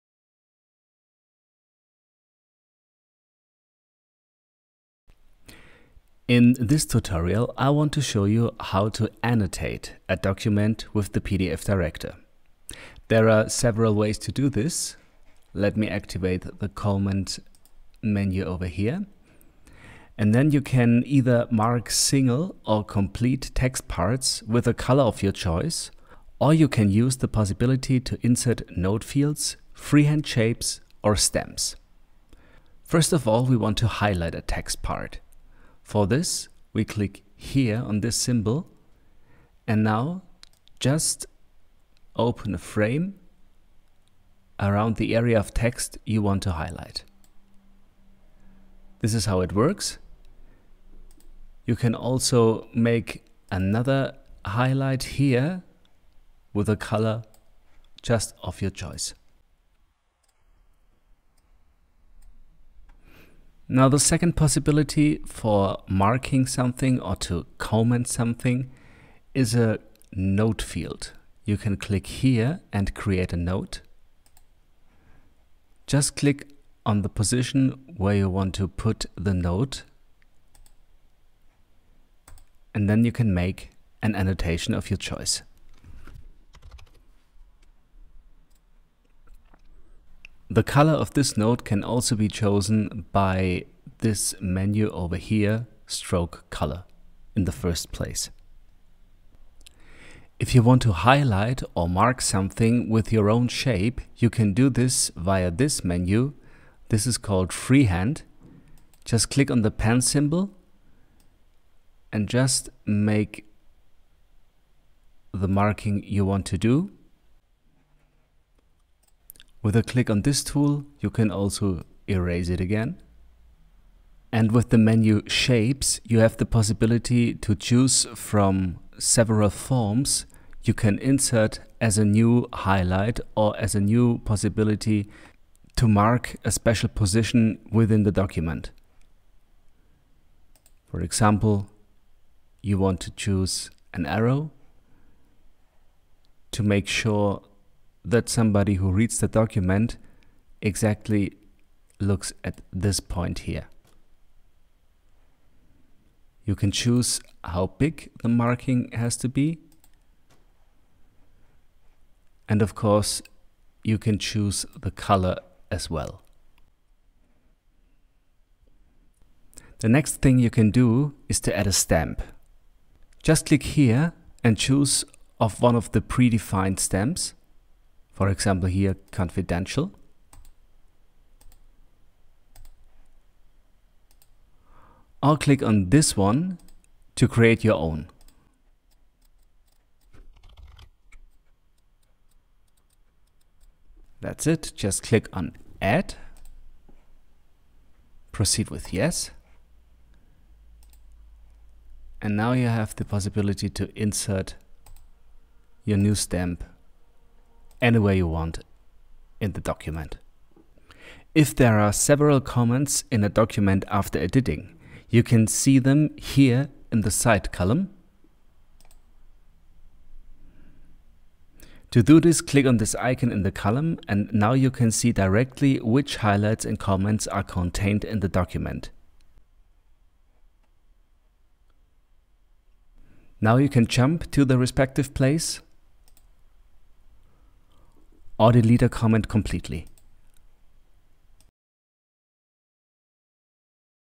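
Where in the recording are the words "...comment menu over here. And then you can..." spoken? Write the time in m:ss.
0:16.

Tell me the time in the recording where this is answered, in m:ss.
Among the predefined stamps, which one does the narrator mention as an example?
2:59.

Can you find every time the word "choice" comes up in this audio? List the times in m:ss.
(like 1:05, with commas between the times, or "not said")
0:25, 0:58, 1:24.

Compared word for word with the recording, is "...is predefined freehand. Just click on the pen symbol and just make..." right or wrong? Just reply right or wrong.
wrong.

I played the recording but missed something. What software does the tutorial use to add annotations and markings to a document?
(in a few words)
PDF director.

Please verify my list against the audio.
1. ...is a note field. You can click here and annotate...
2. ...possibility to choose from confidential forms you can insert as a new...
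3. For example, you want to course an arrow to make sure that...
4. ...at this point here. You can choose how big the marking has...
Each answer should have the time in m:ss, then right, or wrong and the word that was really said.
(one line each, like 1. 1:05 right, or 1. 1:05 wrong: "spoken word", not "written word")
1. 1:09 wrong: "create", not "annotate"
2. 2:06 wrong: "several", not "confidential"
3. 2:20 wrong: "choose", not "course"
4. 2:32 right.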